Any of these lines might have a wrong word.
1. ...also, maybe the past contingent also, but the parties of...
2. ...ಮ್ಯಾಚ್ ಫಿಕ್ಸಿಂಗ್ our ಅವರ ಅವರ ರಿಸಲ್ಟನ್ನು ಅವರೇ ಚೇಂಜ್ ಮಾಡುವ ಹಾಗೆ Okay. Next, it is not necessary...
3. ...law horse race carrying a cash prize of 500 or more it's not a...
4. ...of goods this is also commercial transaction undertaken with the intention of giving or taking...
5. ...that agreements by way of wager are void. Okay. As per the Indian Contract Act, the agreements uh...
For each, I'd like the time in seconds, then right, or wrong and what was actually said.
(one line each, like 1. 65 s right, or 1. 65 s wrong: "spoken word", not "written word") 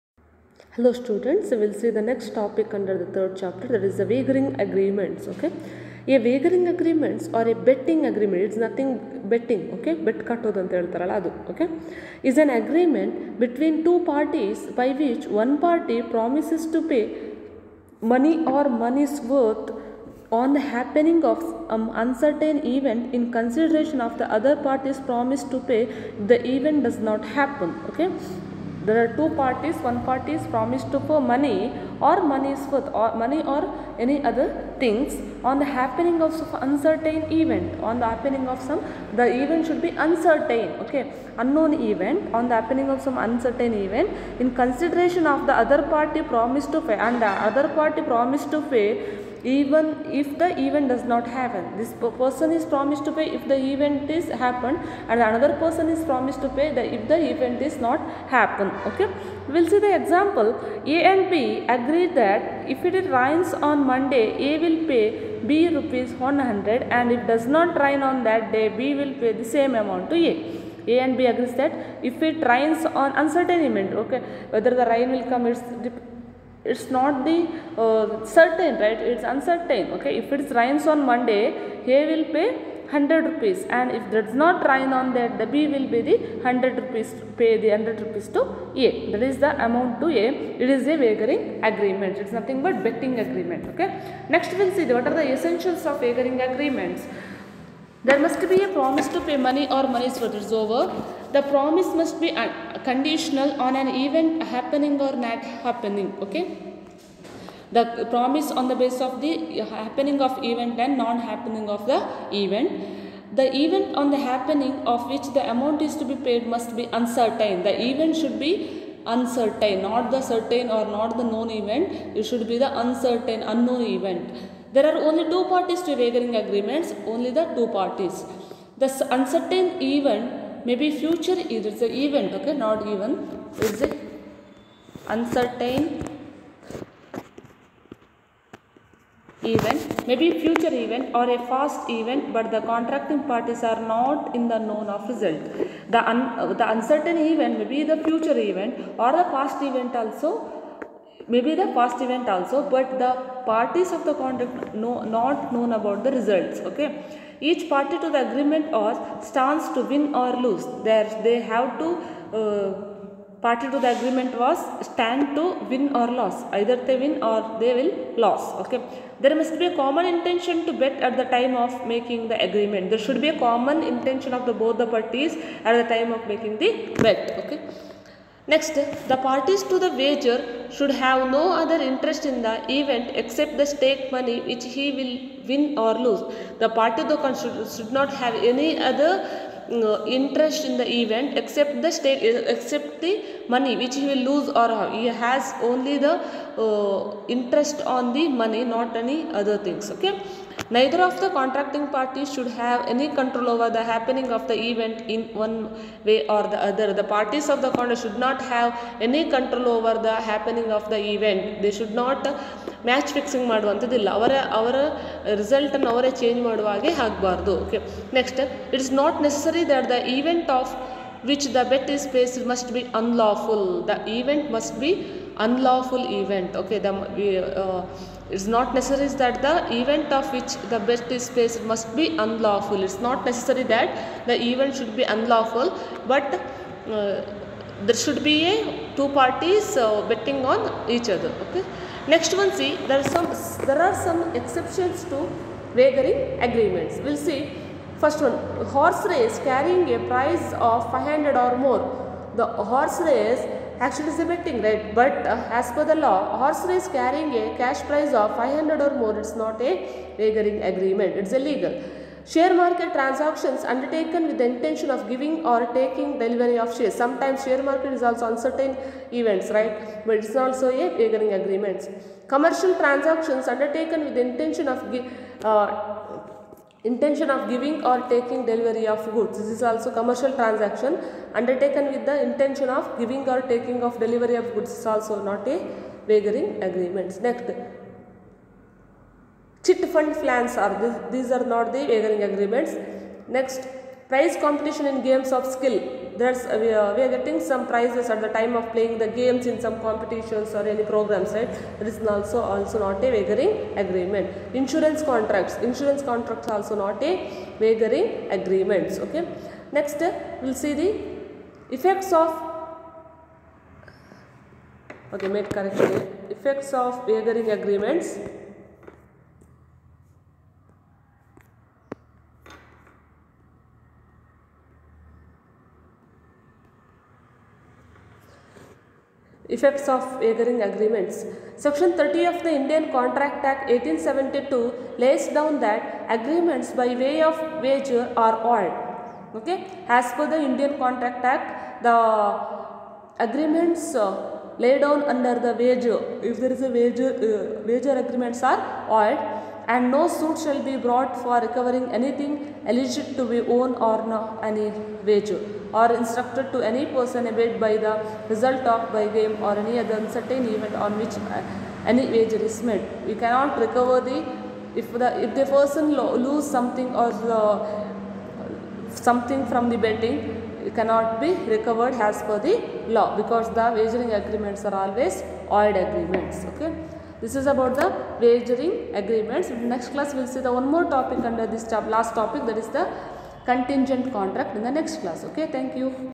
1. 149 s wrong: "event", not "contingent"
2. 212 s right
3. 256 s right
4. 278 s right
5. 335 s right.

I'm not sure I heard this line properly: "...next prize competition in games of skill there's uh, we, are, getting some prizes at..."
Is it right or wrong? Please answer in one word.
right.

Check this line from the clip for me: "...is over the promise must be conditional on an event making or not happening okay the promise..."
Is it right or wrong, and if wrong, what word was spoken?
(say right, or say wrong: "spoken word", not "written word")
wrong: "happening", not "making".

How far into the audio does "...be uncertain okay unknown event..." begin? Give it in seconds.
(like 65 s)
39 s.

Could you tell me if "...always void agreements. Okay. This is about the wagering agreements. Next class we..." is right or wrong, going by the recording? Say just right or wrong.
right.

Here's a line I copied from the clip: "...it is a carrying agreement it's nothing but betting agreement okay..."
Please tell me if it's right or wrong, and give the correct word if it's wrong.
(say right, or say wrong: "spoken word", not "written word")
wrong: "wagering", not "carrying".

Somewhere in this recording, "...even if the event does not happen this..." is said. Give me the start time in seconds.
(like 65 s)
49 s.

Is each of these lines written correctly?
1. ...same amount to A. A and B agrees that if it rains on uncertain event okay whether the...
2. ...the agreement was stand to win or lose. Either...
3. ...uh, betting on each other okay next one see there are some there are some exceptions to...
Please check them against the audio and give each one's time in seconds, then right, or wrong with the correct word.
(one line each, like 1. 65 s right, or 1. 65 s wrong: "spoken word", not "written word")
1. 69 s right
2. 163 s right
3. 239 s right.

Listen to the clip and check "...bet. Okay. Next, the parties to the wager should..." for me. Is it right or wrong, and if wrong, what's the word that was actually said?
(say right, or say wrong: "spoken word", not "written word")
right.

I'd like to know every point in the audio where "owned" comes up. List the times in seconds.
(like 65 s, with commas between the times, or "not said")
353 s.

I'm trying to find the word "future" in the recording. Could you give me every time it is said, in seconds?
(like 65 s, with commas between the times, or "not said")
130 s, 140 s, 148 s.